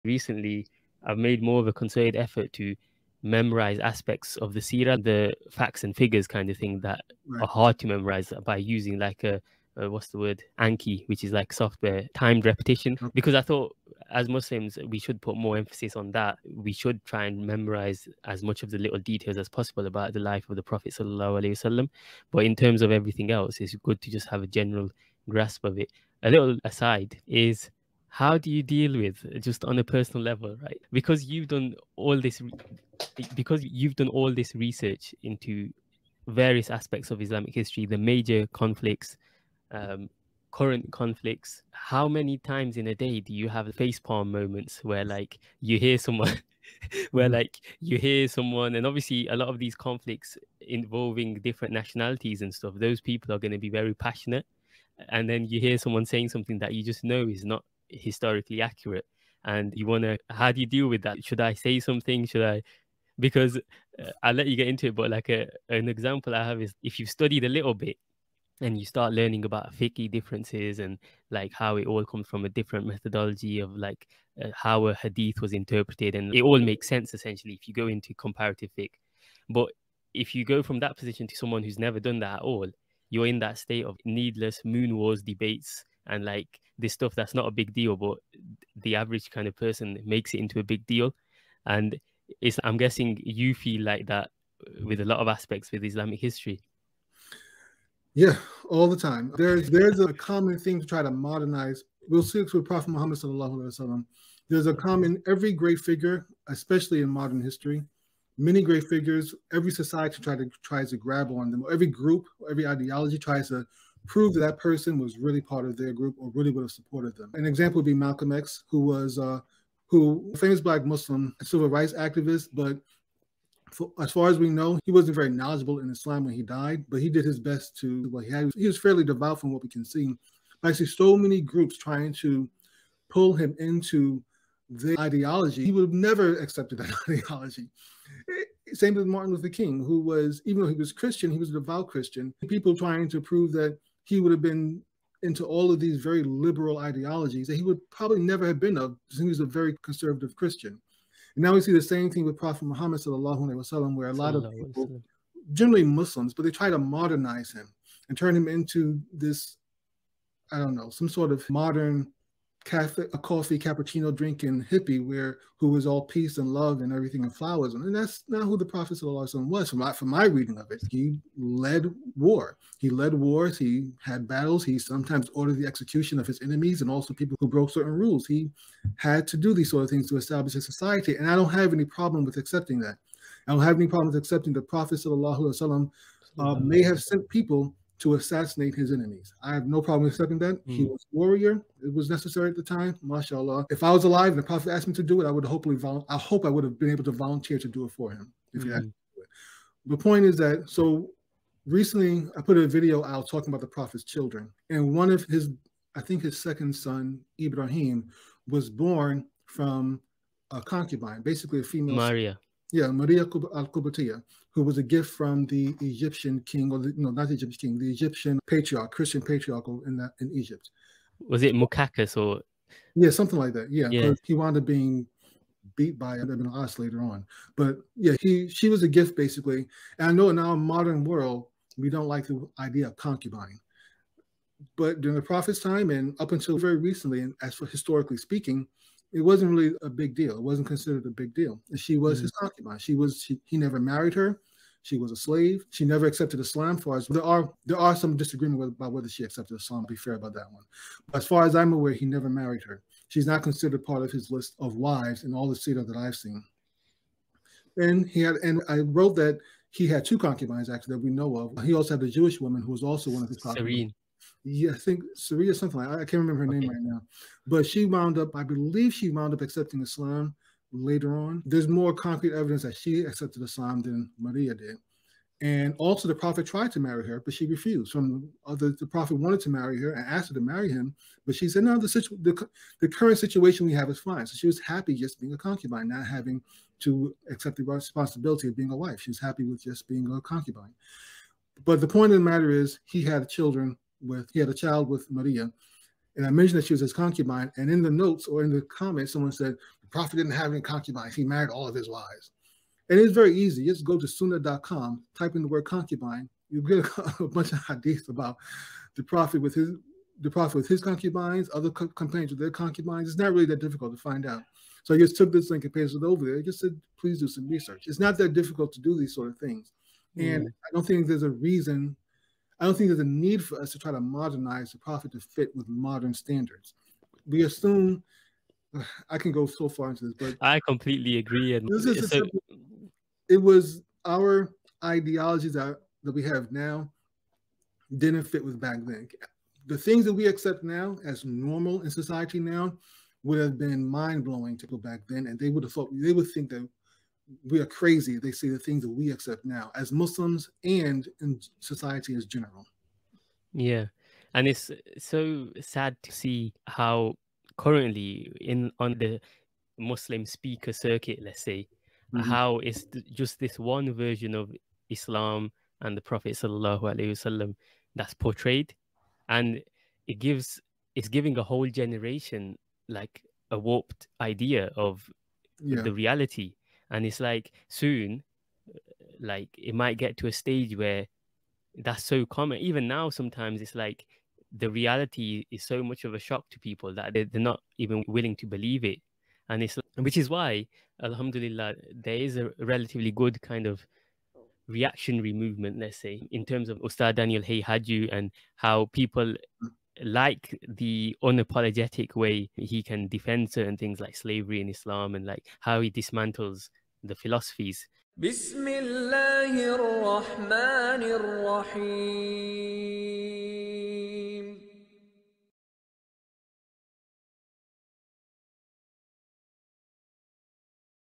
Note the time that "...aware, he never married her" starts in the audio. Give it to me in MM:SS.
04:11.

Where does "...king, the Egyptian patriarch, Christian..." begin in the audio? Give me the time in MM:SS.
03:37.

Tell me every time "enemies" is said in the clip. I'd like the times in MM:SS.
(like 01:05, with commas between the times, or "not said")
02:56, 03:08.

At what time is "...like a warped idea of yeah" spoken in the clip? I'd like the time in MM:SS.
06:12.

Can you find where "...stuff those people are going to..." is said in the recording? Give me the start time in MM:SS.
00:52.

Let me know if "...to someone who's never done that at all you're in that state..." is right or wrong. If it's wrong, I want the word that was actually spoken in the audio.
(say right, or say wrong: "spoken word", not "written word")
right.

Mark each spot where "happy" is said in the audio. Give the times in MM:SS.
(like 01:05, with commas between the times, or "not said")
04:44, 04:49.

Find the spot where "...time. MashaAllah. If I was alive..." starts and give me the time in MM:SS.
03:12.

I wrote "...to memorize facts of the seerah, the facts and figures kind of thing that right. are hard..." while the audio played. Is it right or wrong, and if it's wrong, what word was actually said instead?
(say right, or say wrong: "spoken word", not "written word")
wrong: "aspects", not "facts".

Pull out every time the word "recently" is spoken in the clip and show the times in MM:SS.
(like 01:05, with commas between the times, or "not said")
00:00, 03:21, 03:56.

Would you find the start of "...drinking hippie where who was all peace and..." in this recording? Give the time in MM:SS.
02:44.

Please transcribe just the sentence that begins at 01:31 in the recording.
And it's, I'm guessing you feel like that with a lot of aspects with Islamic history.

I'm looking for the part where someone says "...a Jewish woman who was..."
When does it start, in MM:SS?
04:22.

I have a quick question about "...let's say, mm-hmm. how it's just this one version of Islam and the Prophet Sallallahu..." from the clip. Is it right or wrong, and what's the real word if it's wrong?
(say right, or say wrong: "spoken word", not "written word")
right.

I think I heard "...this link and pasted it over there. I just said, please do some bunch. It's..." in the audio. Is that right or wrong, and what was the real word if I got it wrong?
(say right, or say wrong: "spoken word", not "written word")
wrong: "research", not "bunch".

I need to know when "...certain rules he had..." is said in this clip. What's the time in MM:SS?
02:57.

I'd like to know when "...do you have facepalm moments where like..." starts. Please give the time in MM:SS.
00:43.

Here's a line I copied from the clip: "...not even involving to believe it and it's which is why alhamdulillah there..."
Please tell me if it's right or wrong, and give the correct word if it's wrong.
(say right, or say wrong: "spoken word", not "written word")
wrong: "willing", not "involving".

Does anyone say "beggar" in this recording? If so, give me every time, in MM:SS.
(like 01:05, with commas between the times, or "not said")
not said.